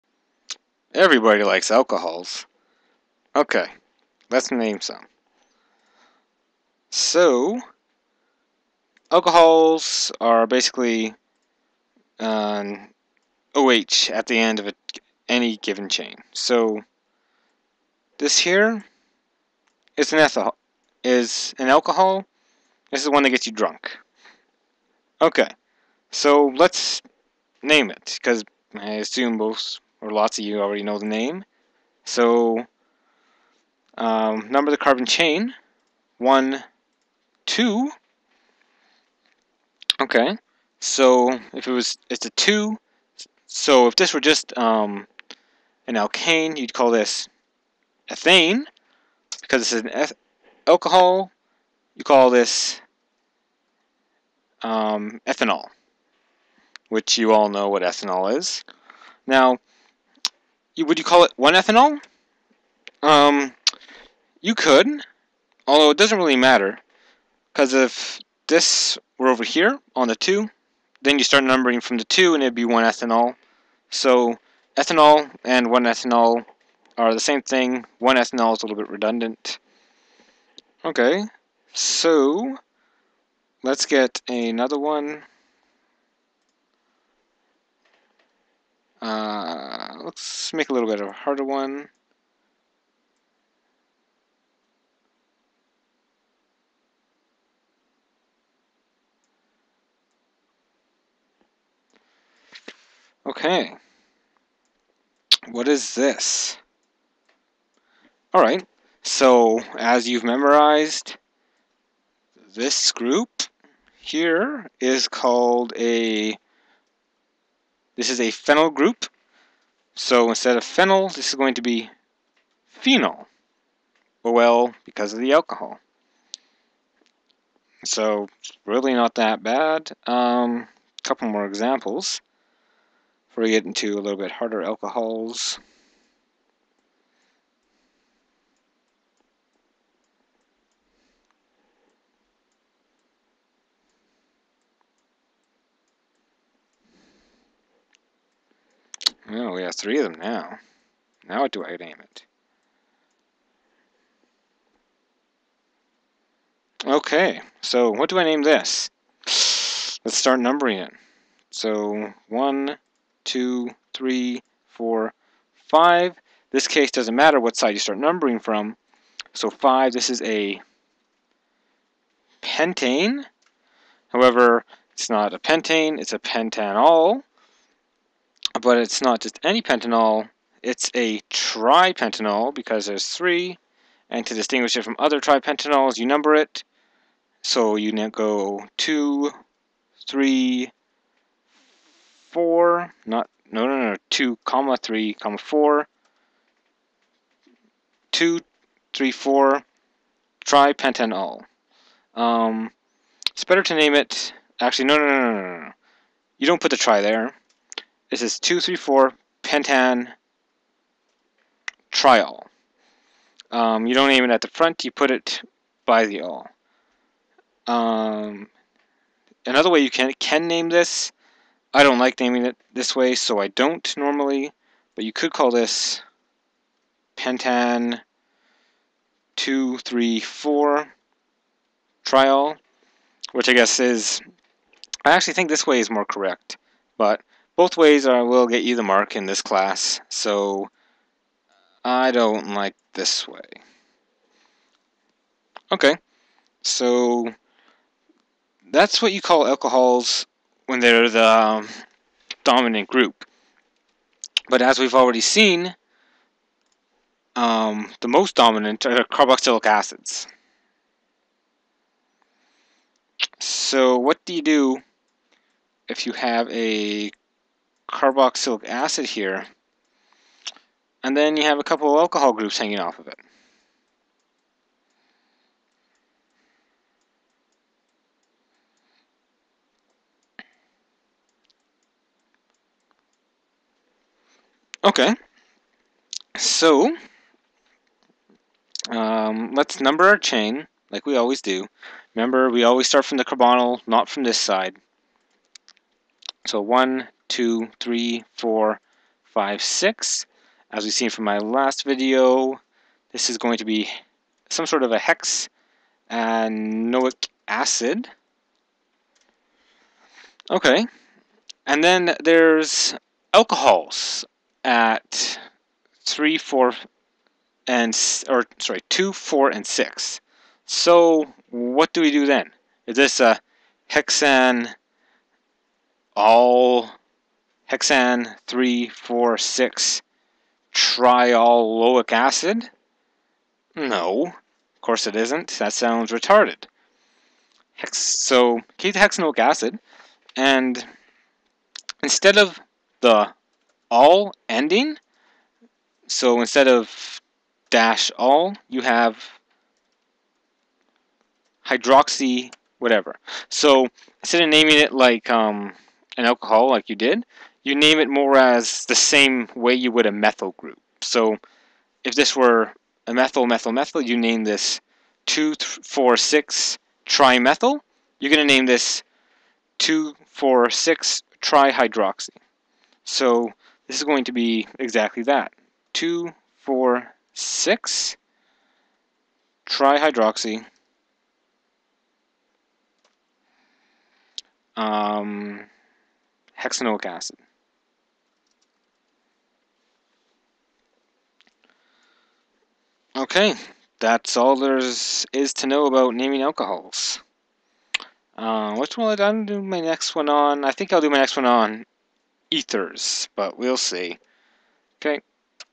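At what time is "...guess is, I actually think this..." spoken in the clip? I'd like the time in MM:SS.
03:53.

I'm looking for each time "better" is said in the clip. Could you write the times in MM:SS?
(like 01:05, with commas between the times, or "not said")
03:23.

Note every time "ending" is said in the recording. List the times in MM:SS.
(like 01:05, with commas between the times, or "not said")
05:44.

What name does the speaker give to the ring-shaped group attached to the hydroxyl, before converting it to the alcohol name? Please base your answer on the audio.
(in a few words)
phenyl group.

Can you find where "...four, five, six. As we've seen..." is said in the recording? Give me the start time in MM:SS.
04:58.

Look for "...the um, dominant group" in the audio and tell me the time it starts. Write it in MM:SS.
04:11.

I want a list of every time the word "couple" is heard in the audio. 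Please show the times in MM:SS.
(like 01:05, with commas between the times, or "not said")
02:11, 04:31.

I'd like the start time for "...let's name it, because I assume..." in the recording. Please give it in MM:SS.
00:26.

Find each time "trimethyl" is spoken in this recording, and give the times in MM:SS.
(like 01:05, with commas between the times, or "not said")
06:07.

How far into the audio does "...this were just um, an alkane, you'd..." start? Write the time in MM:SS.
00:43.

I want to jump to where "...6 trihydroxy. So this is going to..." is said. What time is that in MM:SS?
06:10.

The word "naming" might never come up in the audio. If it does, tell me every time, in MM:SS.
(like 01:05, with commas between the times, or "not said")
03:42, 05:54, 06:36.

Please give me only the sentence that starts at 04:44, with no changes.
Okay, so um, let's number our chain like we always do.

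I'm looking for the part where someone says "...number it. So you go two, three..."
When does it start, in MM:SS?
03:06.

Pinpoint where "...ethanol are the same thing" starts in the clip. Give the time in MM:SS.
01:15.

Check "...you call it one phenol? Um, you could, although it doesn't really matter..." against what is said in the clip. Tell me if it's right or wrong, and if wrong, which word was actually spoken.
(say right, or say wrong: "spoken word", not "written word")
wrong: "ethanol", not "phenol".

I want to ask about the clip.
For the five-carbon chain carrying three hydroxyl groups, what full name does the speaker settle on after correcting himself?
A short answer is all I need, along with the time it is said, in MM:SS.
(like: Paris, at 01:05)
2,3,4-pentanetriol, at 03:28.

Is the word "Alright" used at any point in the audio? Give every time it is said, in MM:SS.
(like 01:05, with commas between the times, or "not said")
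01:48.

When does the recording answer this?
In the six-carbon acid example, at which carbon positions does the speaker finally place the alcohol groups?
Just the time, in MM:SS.
05:18.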